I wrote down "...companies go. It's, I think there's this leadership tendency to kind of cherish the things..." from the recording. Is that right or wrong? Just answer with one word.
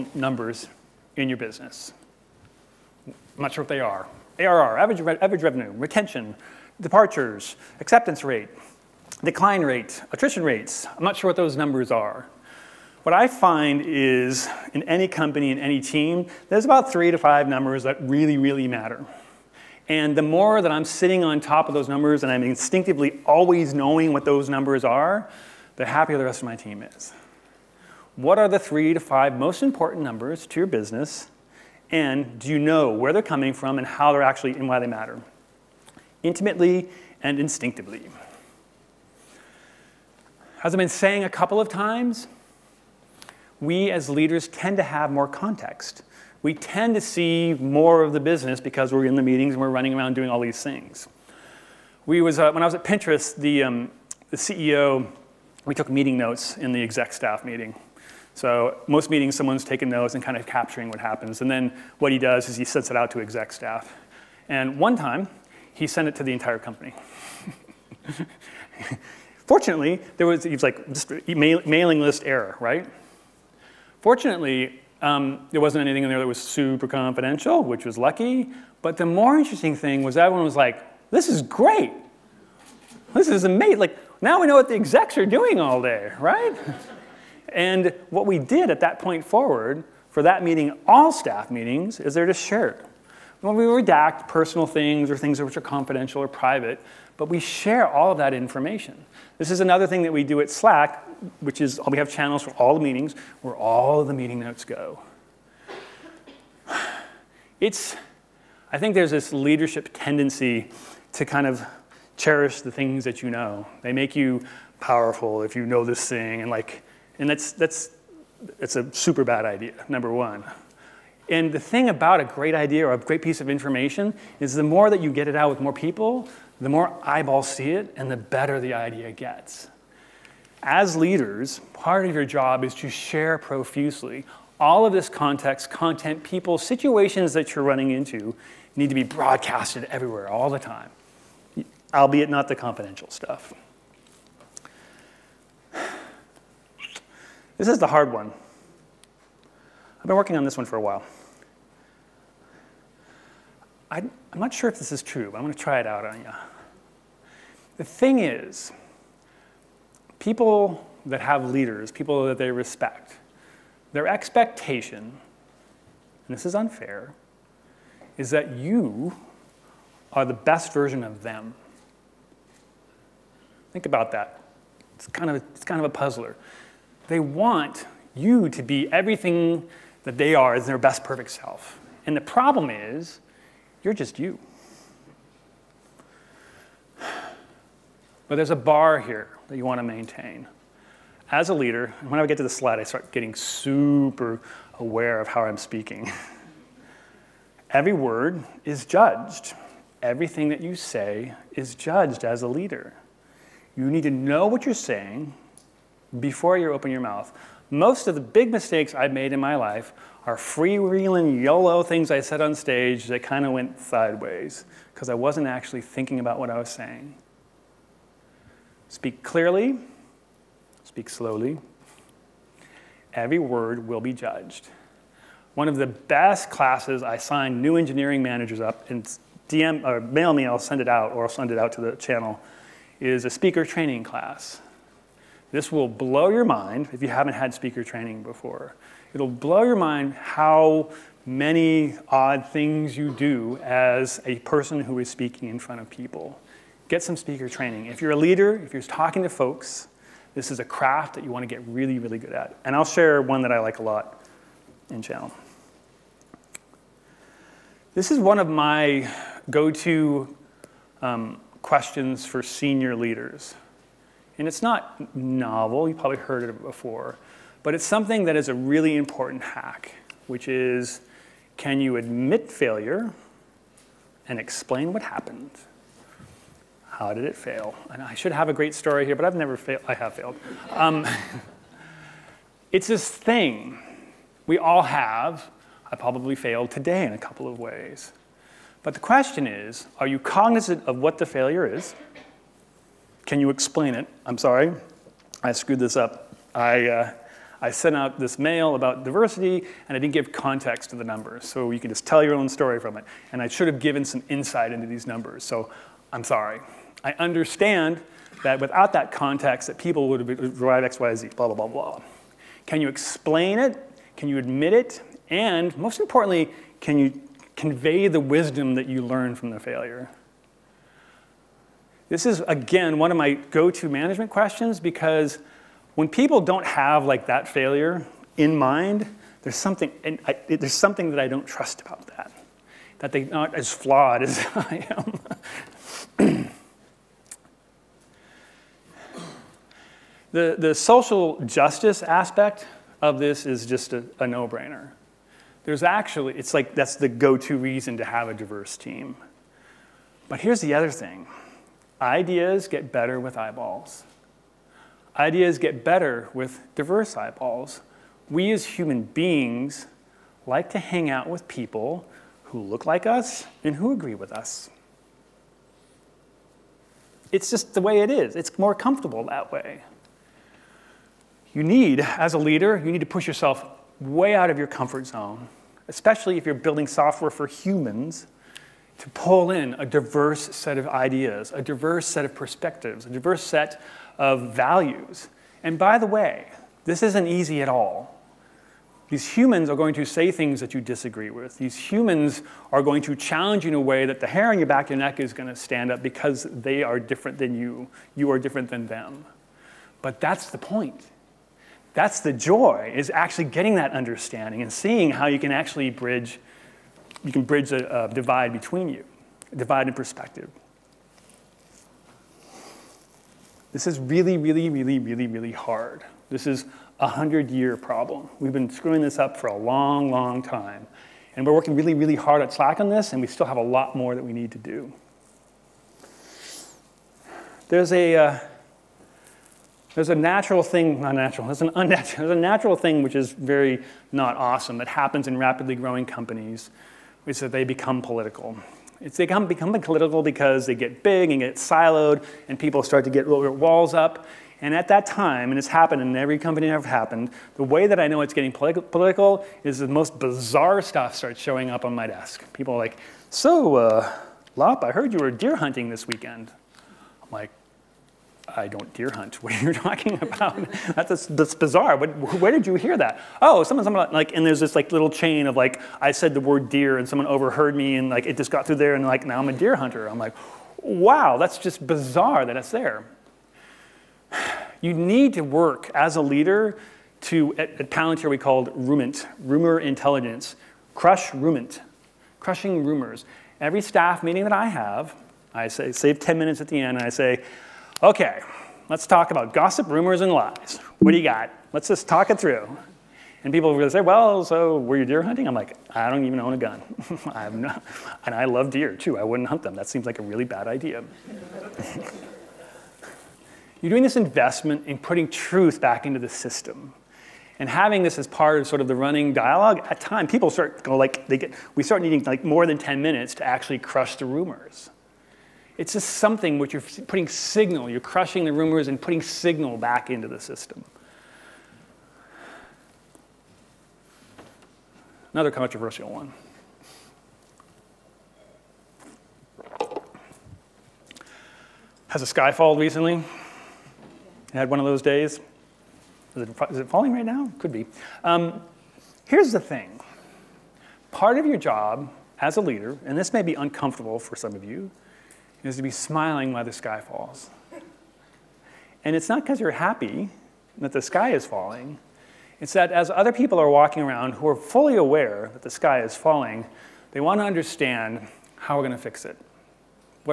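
wrong.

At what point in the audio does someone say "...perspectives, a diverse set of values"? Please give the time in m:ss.
6:22.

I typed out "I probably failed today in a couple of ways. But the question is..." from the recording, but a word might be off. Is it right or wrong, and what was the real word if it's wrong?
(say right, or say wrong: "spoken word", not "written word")
right.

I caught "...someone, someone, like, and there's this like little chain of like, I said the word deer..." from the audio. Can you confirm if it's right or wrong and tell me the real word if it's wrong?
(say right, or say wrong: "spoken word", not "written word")
right.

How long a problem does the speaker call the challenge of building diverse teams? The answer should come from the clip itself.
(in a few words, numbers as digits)
100 year problem.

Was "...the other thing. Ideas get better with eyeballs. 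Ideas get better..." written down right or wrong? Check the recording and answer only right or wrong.
right.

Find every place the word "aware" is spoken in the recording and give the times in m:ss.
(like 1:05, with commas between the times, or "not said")
3:14, 9:14.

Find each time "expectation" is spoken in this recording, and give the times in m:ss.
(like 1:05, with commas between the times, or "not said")
2:44.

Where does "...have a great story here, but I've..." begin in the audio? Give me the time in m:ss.
4:38.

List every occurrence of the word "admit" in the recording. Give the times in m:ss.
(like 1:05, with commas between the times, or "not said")
4:31, 5:14.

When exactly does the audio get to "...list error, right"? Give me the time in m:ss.
1:11.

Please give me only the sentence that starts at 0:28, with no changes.
What are the three to five most important numbers to your business?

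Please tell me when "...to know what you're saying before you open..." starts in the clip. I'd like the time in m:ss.
3:24.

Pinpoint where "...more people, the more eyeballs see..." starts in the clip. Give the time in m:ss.
2:05.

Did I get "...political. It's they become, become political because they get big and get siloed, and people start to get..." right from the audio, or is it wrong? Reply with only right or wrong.
right.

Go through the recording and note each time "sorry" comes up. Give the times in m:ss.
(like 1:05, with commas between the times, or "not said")
4:54, 5:06.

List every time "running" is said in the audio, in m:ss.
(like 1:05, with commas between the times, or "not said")
0:49, 2:17, 8:28.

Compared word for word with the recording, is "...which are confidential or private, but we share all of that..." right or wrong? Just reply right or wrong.
right.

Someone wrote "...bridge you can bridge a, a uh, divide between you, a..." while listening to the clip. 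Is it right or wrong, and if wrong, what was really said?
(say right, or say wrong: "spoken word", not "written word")
right.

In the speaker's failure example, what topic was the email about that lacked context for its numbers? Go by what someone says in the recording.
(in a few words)
Diversity.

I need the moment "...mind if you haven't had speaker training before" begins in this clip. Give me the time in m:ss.
3:56.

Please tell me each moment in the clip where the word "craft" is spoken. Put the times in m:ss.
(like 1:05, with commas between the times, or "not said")
4:10.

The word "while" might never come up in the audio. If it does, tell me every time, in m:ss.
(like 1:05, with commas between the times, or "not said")
2:30, 9:06.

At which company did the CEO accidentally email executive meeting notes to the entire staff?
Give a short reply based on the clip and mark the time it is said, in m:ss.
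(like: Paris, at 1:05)
Pinterest, at 0:52.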